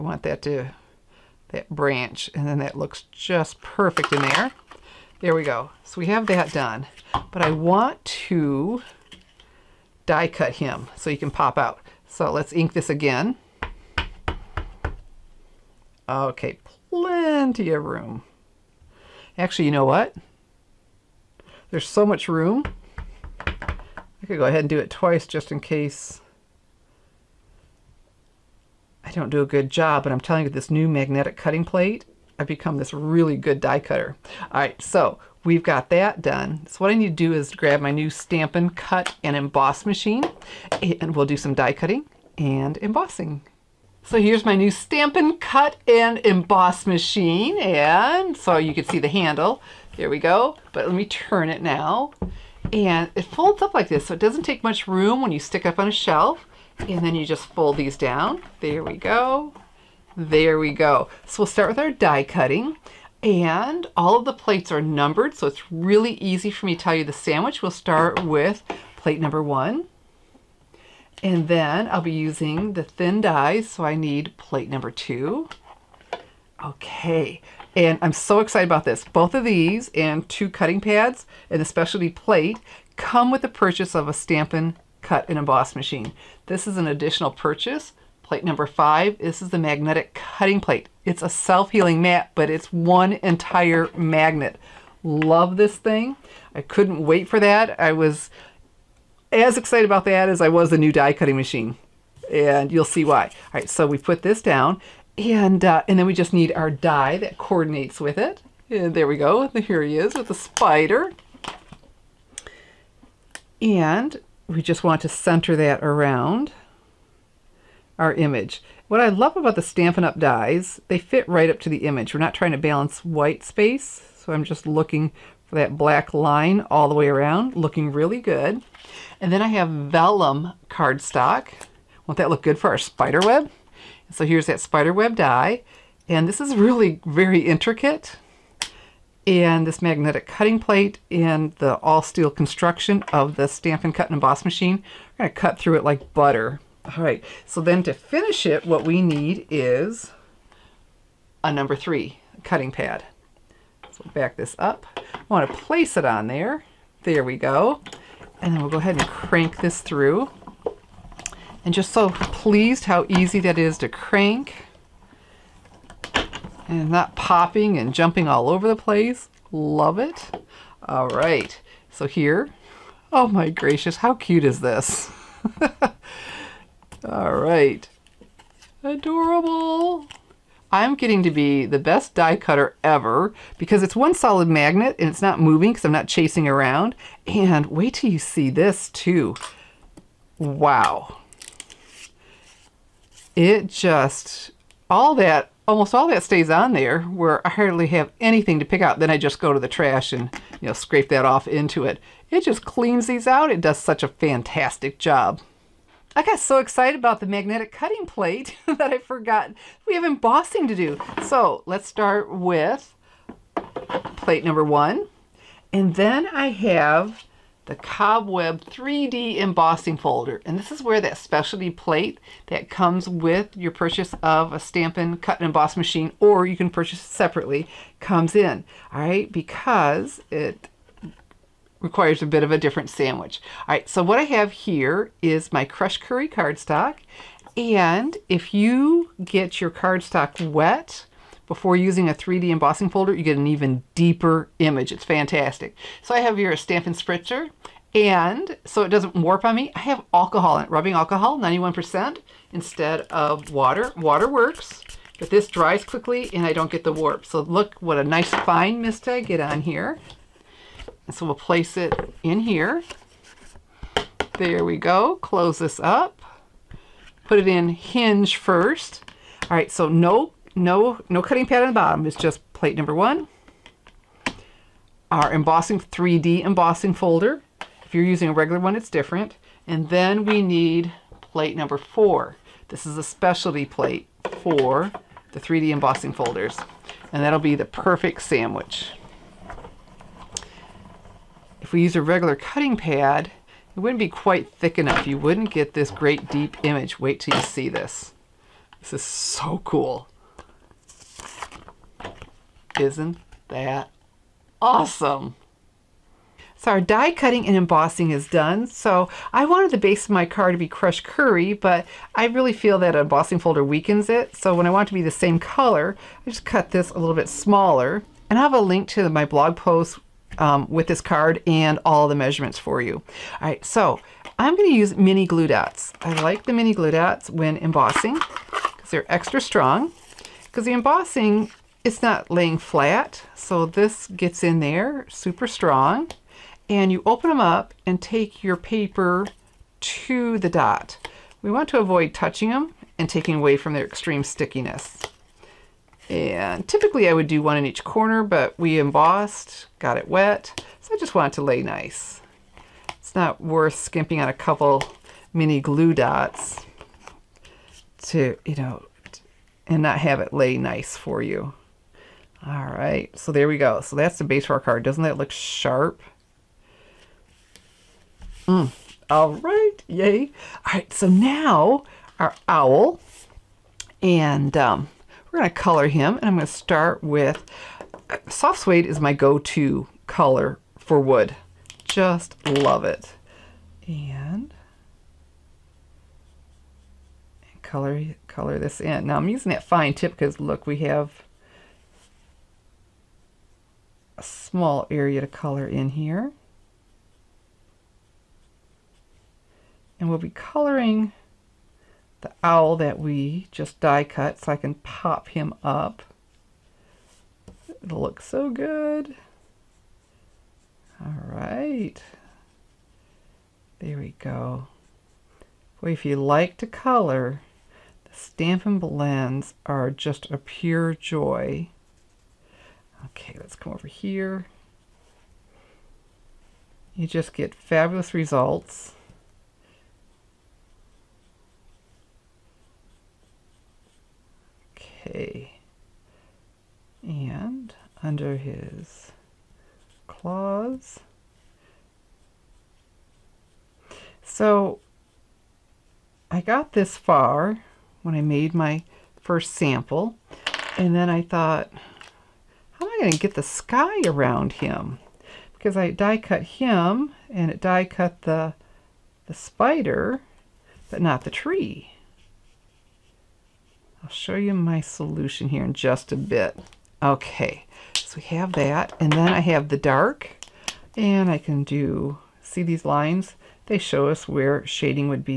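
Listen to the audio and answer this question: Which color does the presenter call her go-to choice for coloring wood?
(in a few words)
Soft suede.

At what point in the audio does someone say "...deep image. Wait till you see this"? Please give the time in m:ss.
4:56.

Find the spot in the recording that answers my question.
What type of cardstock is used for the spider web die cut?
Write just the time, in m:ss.
2:09.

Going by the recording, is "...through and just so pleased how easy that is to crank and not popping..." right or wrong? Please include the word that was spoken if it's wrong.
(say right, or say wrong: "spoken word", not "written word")
right.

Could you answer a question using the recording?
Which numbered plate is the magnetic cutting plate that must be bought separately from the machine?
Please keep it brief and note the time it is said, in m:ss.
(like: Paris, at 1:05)
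5, at 1:28.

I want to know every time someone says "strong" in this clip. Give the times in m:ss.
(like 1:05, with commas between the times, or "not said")
5:29, 5:35.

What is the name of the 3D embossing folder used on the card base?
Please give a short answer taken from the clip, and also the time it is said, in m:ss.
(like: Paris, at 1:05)
Cobweb, at 3:37.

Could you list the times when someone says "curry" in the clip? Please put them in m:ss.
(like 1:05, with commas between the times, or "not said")
3:56, 5:11.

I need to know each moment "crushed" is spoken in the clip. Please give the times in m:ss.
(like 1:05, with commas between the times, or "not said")
3:55, 5:10.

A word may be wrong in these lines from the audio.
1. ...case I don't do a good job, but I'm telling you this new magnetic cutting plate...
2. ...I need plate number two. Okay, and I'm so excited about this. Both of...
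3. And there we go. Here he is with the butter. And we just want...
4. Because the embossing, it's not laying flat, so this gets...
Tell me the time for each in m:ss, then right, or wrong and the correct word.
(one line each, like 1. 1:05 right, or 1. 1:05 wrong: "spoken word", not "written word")
1. 0:25 right
2. 1:13 right
3. 1:48 wrong: "spider", not "butter"
4. 5:30 right.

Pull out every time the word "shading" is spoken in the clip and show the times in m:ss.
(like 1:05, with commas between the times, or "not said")
7:54.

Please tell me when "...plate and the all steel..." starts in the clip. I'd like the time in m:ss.
2:20.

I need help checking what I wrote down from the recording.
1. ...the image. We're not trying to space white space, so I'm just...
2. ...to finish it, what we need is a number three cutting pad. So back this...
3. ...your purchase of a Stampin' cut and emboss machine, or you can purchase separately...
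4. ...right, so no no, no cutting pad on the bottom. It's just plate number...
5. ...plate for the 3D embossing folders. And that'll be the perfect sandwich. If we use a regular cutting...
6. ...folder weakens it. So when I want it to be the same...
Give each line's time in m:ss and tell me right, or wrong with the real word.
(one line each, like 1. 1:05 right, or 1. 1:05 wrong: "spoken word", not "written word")
1. 2:01 wrong: "balance", not "space"
2. 2:27 right
3. 3:43 right
4. 4:29 right
5. 4:43 right
6. 5:13 right.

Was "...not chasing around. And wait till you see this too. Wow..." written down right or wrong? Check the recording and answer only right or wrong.
right.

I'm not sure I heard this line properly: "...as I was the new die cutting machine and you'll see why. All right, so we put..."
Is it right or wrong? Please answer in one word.
right.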